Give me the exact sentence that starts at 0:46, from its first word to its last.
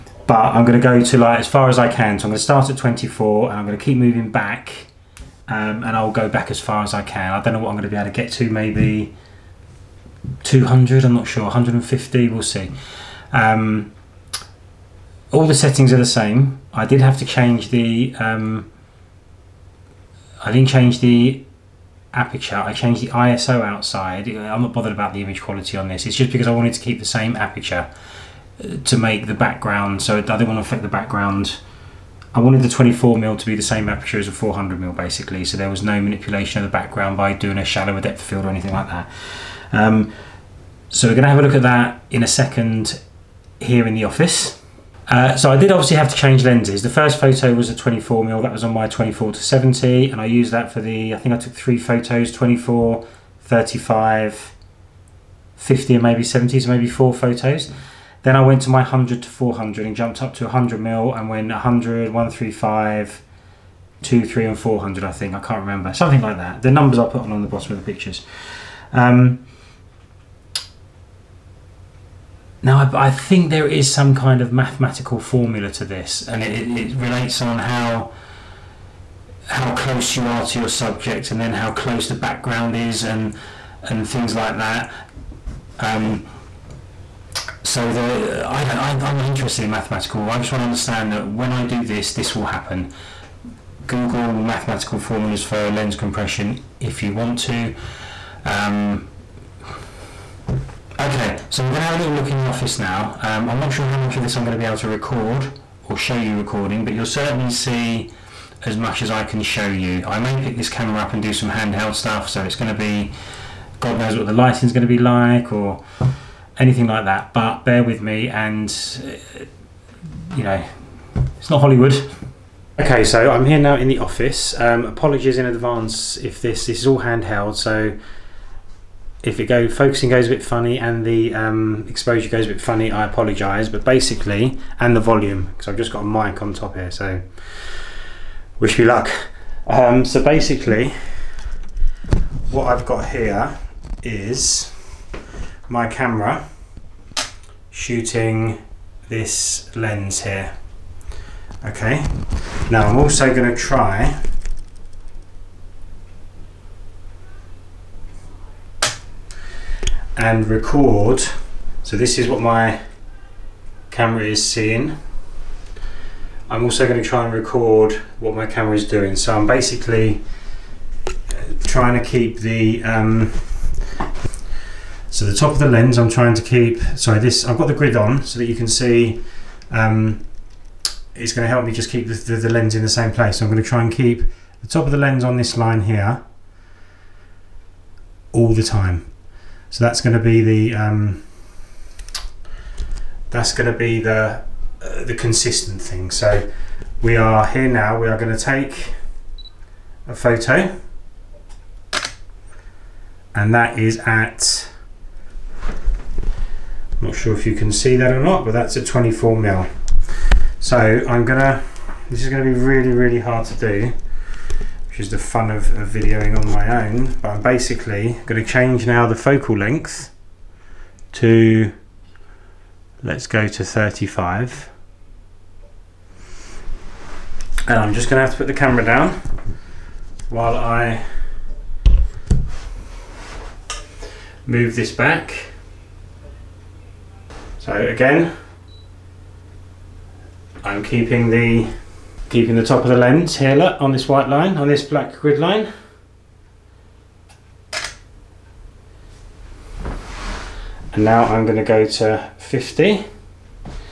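The first photo was a 24 mil.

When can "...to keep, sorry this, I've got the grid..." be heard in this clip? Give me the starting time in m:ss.
2:56.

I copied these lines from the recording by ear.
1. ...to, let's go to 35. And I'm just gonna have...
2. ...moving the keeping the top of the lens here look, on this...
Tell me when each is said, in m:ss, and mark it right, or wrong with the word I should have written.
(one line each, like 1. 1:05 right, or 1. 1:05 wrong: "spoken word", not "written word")
1. 3:41 right
2. 4:00 wrong: "keeping", not "moving".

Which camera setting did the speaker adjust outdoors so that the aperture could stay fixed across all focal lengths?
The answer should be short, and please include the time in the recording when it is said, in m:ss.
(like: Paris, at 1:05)
ISO, at 0:23.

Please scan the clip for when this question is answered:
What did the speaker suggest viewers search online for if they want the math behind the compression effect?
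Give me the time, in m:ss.
1:34.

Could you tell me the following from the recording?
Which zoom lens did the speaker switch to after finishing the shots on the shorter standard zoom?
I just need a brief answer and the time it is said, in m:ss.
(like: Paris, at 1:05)
100 to 400, at 0:58.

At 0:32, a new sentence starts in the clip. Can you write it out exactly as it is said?
I wanted the 24 mil to be the same aperture as a 400 mil basically.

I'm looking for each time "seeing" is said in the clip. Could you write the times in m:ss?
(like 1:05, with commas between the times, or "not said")
2:44.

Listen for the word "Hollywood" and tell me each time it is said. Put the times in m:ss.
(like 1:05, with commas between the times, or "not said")
2:01.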